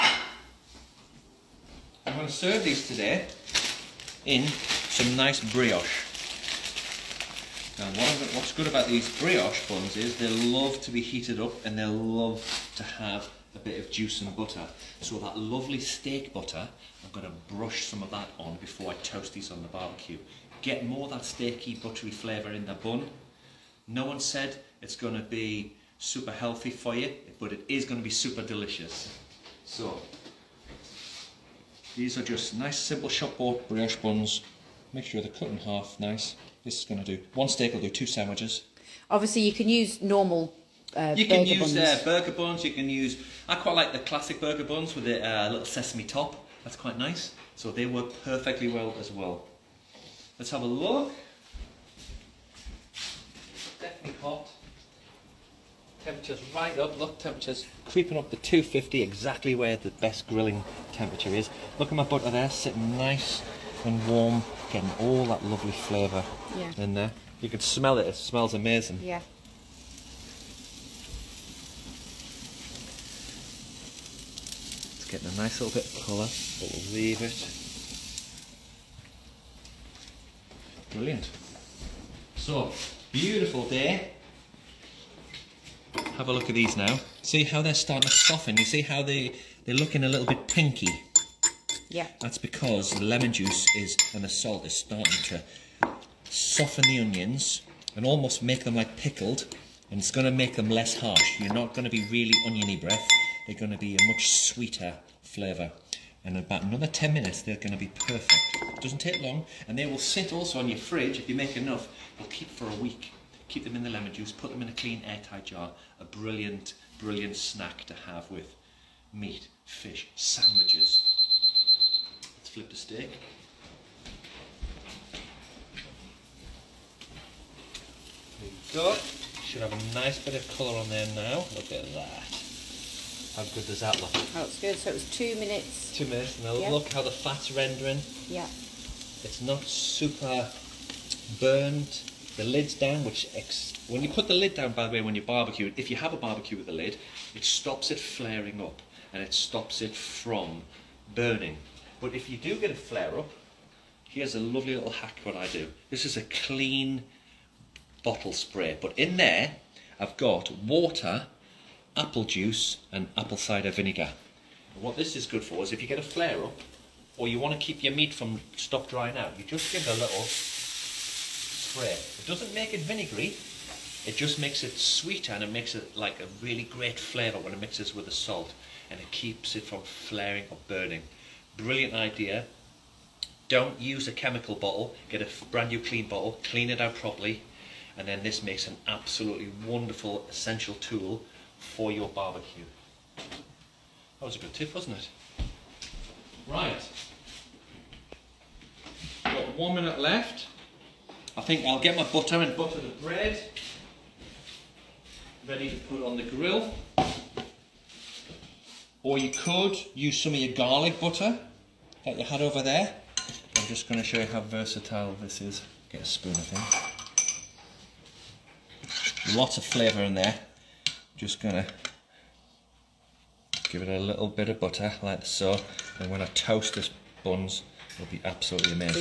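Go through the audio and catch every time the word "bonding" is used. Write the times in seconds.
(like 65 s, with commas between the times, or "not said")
not said.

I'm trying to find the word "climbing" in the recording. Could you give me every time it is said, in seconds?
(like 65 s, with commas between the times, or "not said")
not said.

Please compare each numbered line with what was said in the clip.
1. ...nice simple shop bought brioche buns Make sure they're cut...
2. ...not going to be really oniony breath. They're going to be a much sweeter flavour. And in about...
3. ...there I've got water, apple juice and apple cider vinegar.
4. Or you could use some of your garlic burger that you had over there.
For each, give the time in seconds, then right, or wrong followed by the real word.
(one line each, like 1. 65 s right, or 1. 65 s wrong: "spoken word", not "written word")
1. 32 s right
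2. 101 s right
3. 159 s right
4. 209 s wrong: "butter", not "burger".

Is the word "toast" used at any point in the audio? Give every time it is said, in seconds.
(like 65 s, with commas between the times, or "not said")
19 s, 226 s.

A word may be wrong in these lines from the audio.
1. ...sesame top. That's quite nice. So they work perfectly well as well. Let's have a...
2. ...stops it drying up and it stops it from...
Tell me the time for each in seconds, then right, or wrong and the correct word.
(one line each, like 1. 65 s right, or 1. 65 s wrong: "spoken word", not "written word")
1. 45 s right
2. 147 s wrong: "flaring", not "drying".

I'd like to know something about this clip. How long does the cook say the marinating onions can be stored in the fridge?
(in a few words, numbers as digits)
A week.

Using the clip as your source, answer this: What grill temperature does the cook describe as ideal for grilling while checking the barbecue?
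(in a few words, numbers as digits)
250.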